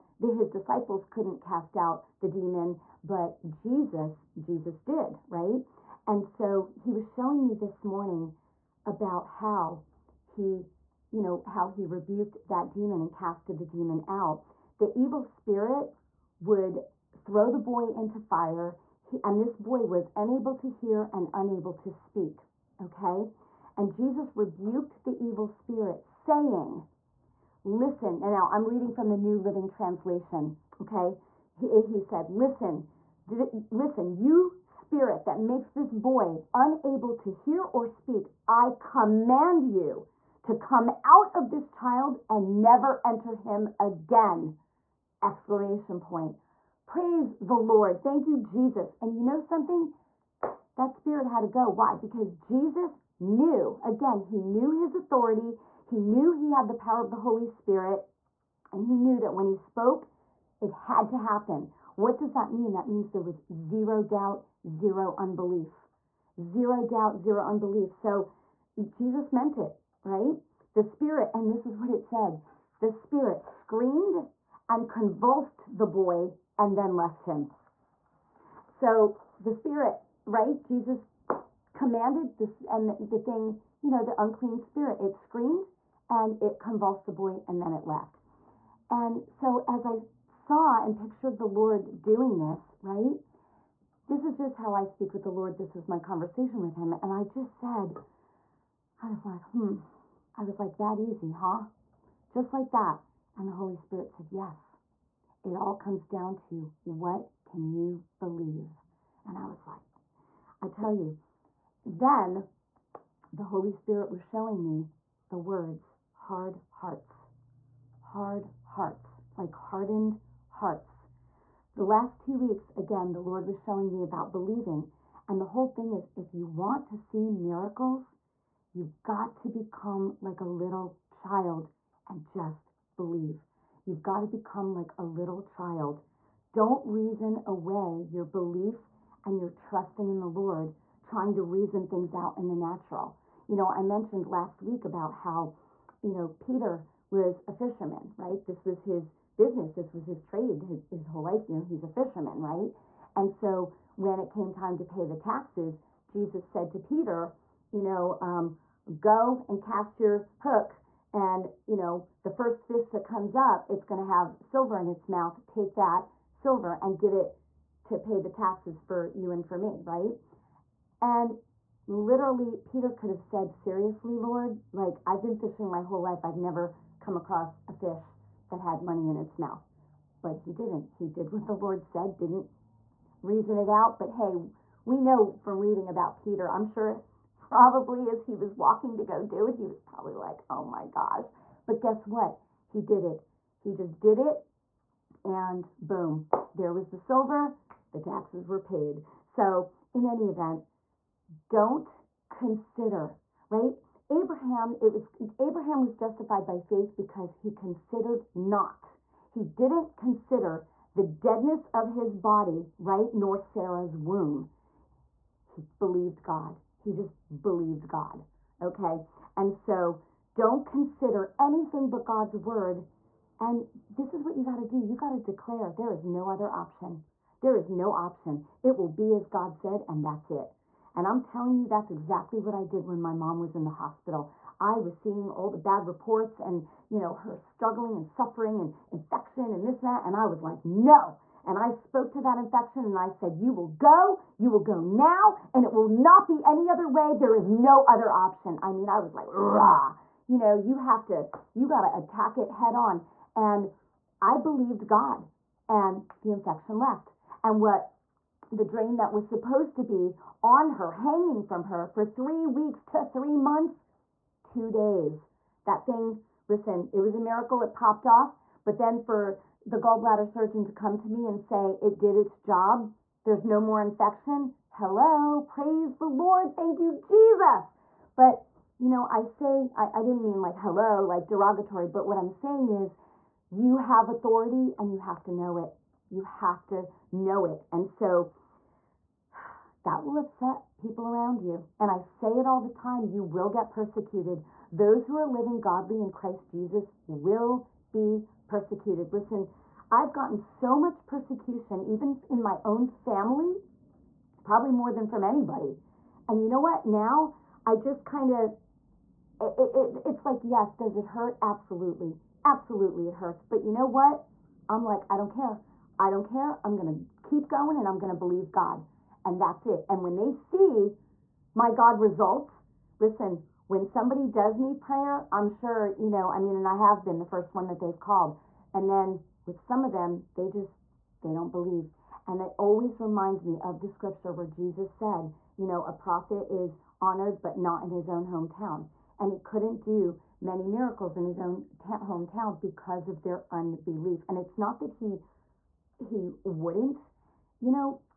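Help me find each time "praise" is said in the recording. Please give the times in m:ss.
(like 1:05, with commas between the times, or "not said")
0:46, 4:35.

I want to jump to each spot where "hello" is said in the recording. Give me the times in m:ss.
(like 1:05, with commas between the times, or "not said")
4:34, 4:40.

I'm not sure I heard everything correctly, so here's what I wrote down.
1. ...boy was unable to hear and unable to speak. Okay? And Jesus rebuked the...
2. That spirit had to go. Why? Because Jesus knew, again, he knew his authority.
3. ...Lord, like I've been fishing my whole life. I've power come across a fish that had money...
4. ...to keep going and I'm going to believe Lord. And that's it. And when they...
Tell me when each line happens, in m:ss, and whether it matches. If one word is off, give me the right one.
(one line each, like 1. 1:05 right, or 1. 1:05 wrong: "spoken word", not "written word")
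1. 0:19 right
2. 0:50 right
3. 2:54 wrong: "never", not "power"
4. 5:16 wrong: "God", not "Lord".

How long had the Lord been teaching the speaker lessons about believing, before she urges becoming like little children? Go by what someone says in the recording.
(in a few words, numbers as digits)
2 weeks.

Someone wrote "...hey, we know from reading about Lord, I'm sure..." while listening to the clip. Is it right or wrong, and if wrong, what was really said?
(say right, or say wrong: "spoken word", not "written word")
wrong: "Peter", not "Lord".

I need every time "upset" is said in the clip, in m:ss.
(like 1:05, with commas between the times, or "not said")
4:50.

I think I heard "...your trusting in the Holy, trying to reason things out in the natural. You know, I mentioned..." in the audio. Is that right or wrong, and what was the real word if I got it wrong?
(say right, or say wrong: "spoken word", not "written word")
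wrong: "Lord", not "Holy".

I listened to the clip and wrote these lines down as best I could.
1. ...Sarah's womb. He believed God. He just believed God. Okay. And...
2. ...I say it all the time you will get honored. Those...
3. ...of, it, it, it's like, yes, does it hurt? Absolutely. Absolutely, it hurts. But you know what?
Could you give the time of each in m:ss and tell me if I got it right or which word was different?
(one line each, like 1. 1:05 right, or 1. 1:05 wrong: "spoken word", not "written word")
1. 3:33 right
2. 4:51 wrong: "persecuted", not "honored"
3. 5:08 right.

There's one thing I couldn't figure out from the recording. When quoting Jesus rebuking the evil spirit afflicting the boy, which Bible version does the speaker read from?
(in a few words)
New Living Translation.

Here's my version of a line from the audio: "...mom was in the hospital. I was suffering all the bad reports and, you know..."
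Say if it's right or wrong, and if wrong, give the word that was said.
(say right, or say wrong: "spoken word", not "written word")
wrong: "seeing", not "suffering".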